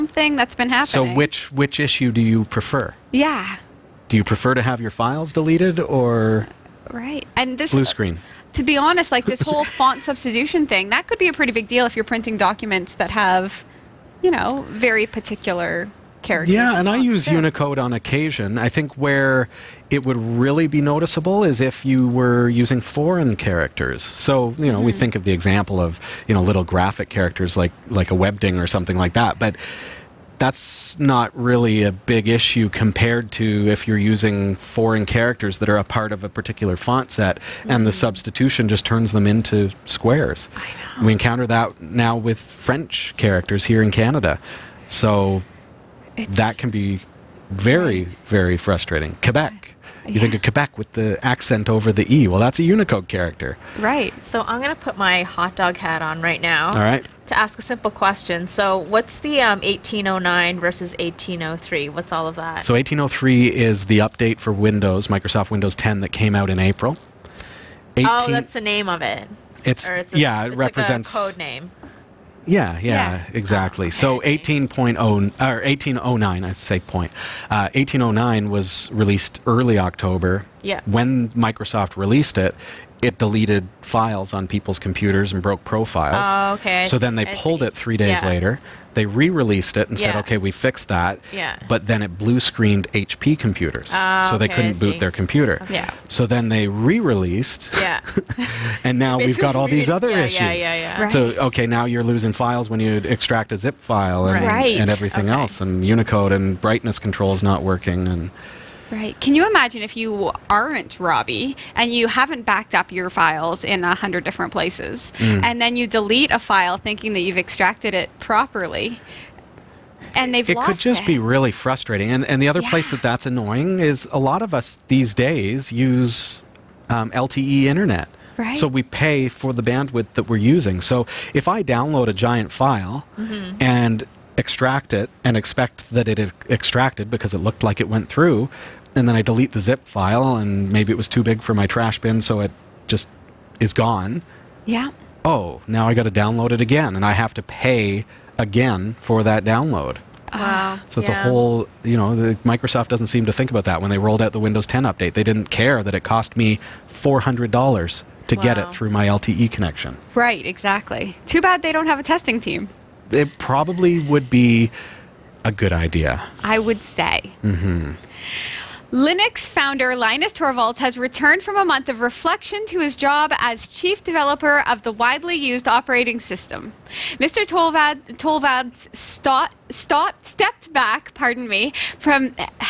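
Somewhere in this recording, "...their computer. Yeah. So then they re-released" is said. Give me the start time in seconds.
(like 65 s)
94 s.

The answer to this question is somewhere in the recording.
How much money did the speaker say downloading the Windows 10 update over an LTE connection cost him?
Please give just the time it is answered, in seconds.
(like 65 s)
156 s.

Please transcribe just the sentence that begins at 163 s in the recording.
It probably would be a good idea.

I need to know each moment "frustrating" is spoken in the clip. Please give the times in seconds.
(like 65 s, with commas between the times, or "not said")
48 s, 121 s.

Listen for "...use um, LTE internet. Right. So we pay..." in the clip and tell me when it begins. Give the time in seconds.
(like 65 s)
125 s.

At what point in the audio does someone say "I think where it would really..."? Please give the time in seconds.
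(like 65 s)
18 s.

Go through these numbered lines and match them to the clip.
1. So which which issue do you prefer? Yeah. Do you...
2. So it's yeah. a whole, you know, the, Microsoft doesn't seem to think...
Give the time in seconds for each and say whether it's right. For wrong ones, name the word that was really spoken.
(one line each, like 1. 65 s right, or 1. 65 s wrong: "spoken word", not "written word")
1. 0 s right
2. 150 s right.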